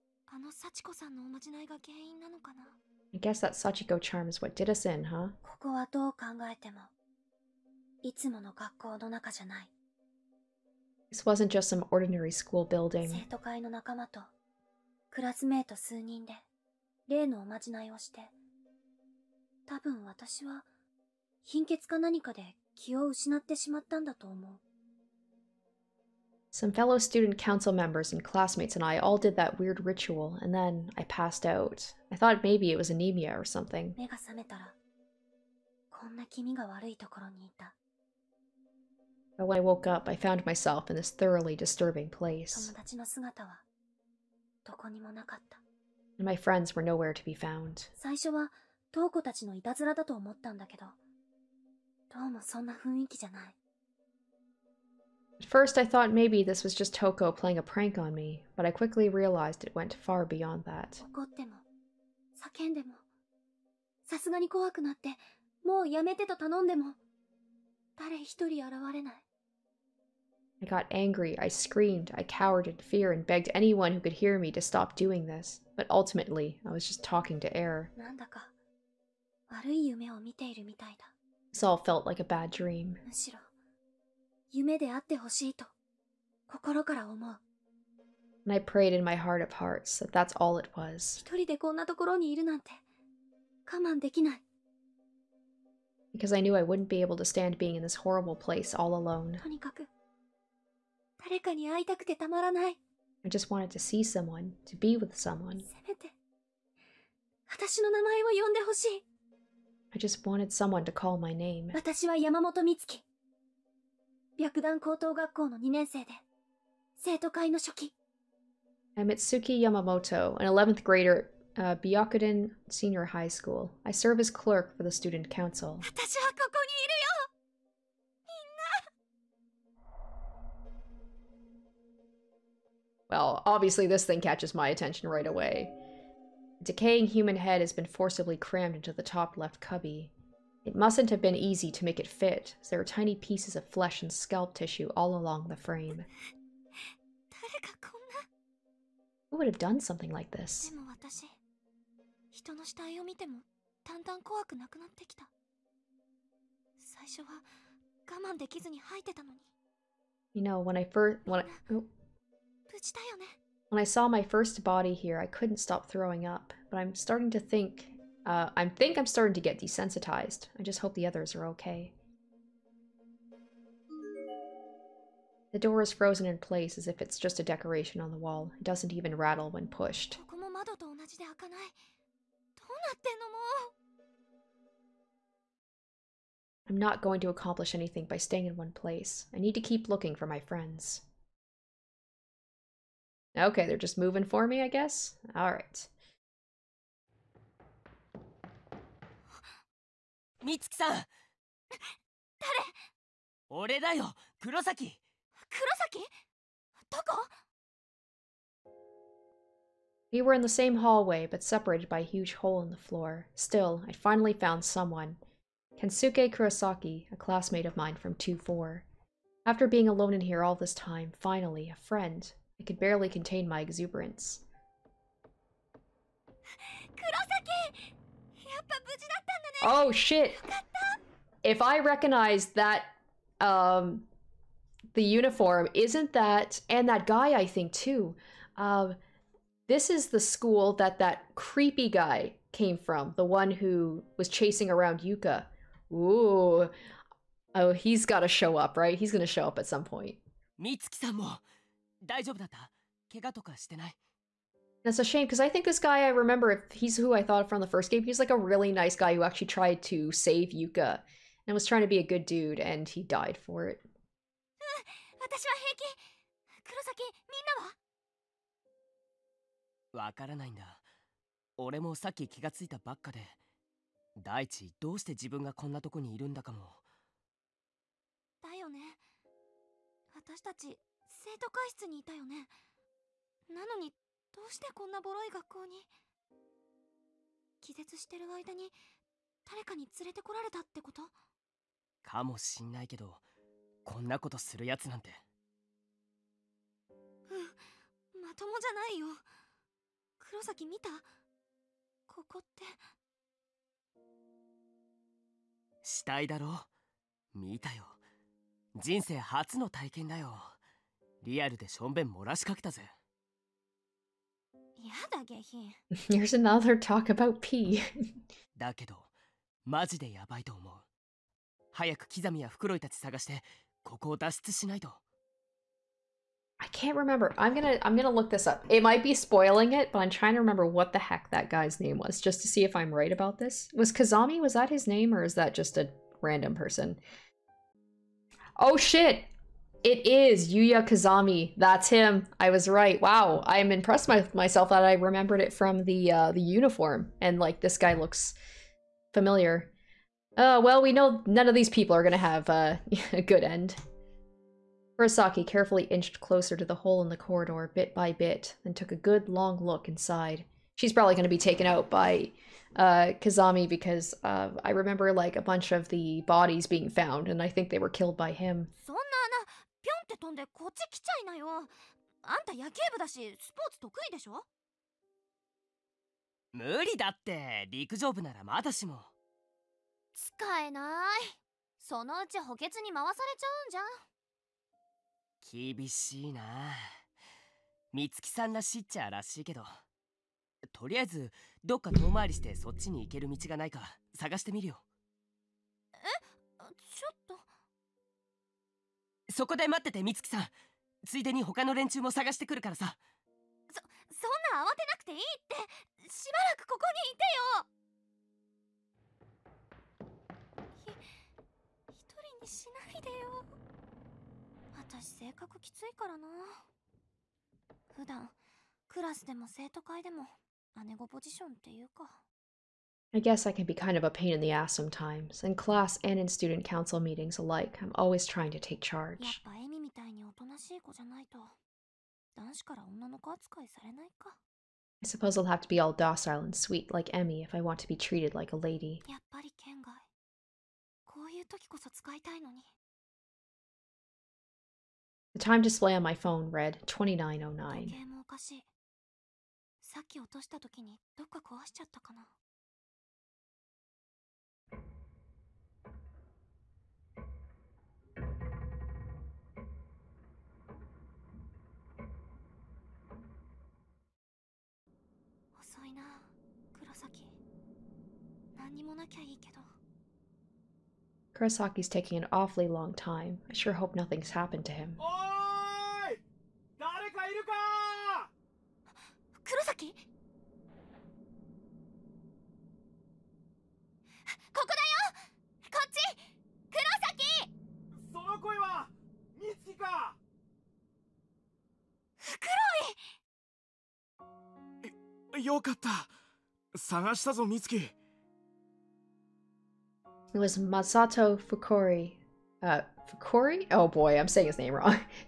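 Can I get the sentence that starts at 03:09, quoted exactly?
I need to keep looking for my friends.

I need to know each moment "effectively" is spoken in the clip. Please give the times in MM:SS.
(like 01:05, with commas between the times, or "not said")
not said.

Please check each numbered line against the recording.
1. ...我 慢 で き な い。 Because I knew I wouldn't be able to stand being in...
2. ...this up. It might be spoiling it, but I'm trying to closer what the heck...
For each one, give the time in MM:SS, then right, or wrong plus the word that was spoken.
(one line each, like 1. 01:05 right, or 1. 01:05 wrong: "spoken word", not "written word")
1. 01:33 right
2. 05:28 wrong: "remember", not "closer".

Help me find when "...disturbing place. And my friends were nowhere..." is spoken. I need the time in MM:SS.
00:41.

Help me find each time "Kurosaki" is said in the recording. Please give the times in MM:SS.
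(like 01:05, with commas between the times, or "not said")
03:36, 03:46, 05:54, 07:51, 07:59, 08:04.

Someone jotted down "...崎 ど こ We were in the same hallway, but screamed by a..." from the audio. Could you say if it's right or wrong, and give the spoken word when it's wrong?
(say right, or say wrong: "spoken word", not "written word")
wrong: "separated", not "screamed".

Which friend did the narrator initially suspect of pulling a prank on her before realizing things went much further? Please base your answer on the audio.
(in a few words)
Toko.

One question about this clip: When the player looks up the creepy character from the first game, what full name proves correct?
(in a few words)
Yuya Kazami.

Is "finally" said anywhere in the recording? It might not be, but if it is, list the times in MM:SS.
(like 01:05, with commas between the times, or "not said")
03:33, 03:41.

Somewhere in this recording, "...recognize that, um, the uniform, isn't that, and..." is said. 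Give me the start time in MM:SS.
03:51.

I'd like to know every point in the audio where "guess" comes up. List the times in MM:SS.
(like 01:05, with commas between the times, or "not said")
00:03, 03:14, 07:03.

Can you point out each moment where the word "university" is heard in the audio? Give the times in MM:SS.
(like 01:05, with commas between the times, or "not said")
not said.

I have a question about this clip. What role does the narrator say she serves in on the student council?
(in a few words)
clerk.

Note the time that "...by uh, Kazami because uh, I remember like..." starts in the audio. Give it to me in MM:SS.
06:01.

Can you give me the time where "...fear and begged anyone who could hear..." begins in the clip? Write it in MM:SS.
01:12.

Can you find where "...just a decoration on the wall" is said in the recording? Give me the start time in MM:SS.
02:57.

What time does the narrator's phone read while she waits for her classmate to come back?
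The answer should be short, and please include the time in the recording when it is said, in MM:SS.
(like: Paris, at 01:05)
2909, at 07:26.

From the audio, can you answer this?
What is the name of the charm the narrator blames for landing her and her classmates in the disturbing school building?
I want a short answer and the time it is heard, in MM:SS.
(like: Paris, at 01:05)
Sachiko charm, at 00:03.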